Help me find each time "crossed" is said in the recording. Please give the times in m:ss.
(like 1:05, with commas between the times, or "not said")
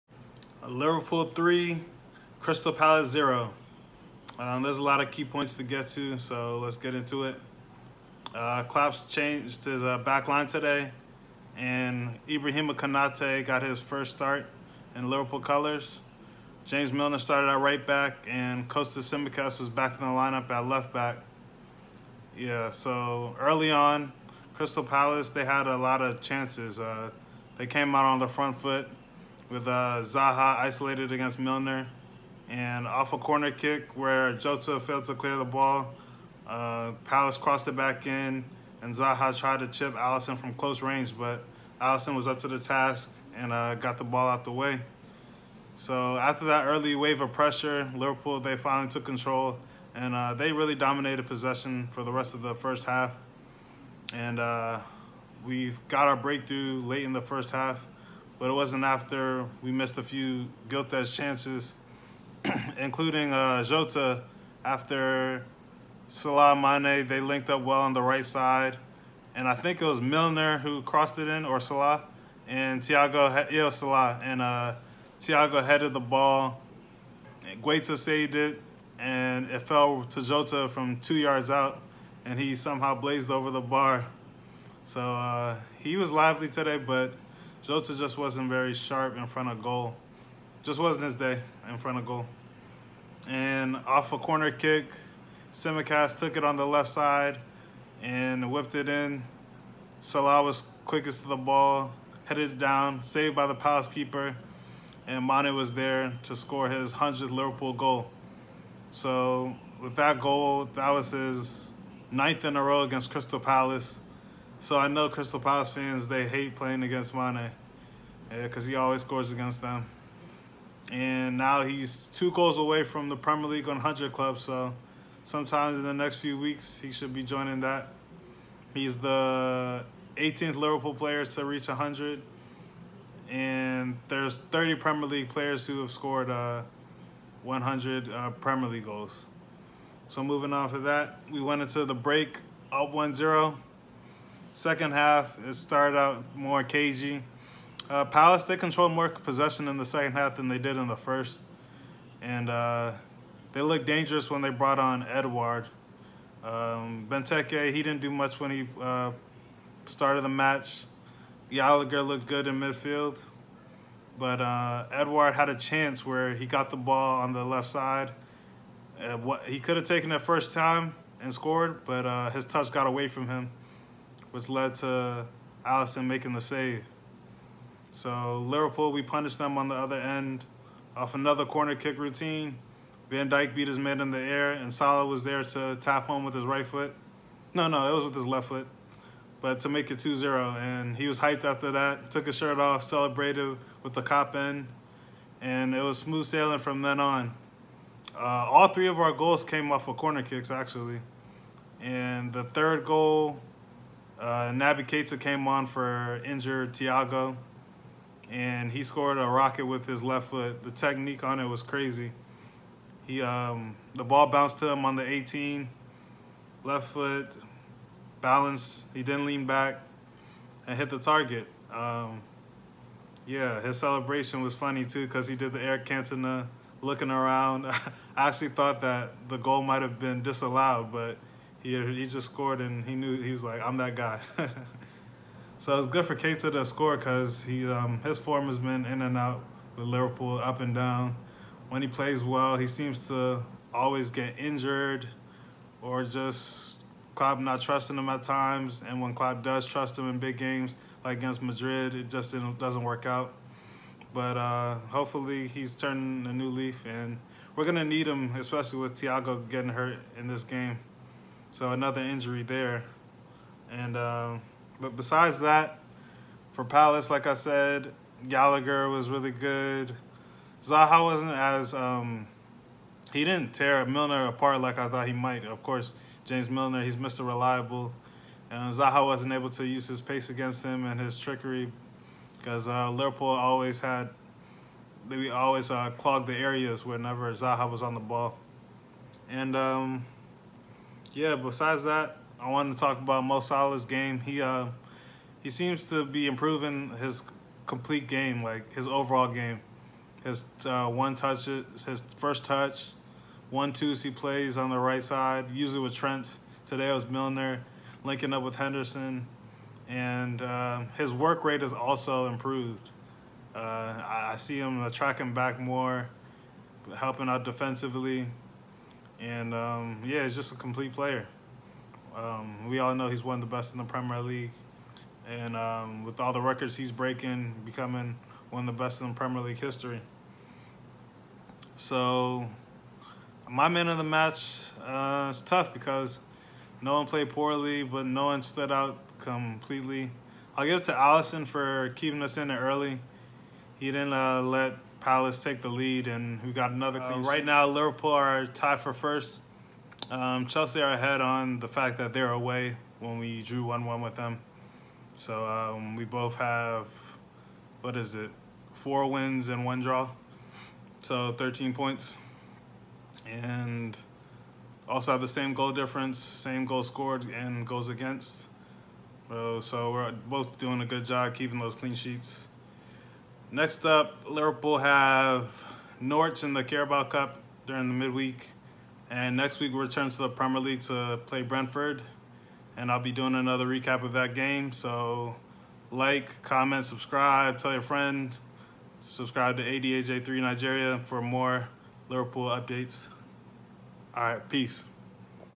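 0:37, 1:10.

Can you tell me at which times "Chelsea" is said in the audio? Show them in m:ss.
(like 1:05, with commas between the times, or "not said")
5:50.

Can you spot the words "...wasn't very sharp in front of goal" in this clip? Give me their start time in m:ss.
1:28.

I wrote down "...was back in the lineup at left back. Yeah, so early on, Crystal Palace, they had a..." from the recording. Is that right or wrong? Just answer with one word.
right.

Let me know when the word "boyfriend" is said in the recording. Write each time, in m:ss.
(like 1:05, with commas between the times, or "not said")
not said.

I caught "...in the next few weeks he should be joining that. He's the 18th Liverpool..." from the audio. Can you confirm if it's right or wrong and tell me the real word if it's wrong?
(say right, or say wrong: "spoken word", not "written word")
right.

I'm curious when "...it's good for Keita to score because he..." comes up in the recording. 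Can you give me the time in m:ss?
3:55.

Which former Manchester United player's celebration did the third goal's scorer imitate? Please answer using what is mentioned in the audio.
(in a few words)
Eric Cantona.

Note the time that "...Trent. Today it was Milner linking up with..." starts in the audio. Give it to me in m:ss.
5:05.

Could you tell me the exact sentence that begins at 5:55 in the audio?
So um, we both have, what is it, four wins and one draw.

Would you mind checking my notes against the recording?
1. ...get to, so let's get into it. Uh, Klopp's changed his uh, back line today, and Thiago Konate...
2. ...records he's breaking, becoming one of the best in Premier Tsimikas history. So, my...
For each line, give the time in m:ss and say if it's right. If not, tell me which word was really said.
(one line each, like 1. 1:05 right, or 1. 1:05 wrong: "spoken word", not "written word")
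1. 0:05 wrong: "Ibrahima", not "Thiago"
2. 5:26 wrong: "League", not "Tsimikas".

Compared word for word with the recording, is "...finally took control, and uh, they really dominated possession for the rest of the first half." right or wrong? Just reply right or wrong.
right.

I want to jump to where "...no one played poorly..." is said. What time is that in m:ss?
5:36.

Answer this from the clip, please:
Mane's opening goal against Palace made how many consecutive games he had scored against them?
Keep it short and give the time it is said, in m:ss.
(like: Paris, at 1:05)
9th, at 1:52.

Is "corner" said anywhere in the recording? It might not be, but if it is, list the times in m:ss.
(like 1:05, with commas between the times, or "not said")
0:33, 1:34, 3:01, 3:19.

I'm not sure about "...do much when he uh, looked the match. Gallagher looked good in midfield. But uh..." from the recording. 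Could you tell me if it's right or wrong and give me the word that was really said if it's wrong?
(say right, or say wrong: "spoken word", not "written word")
wrong: "started", not "looked".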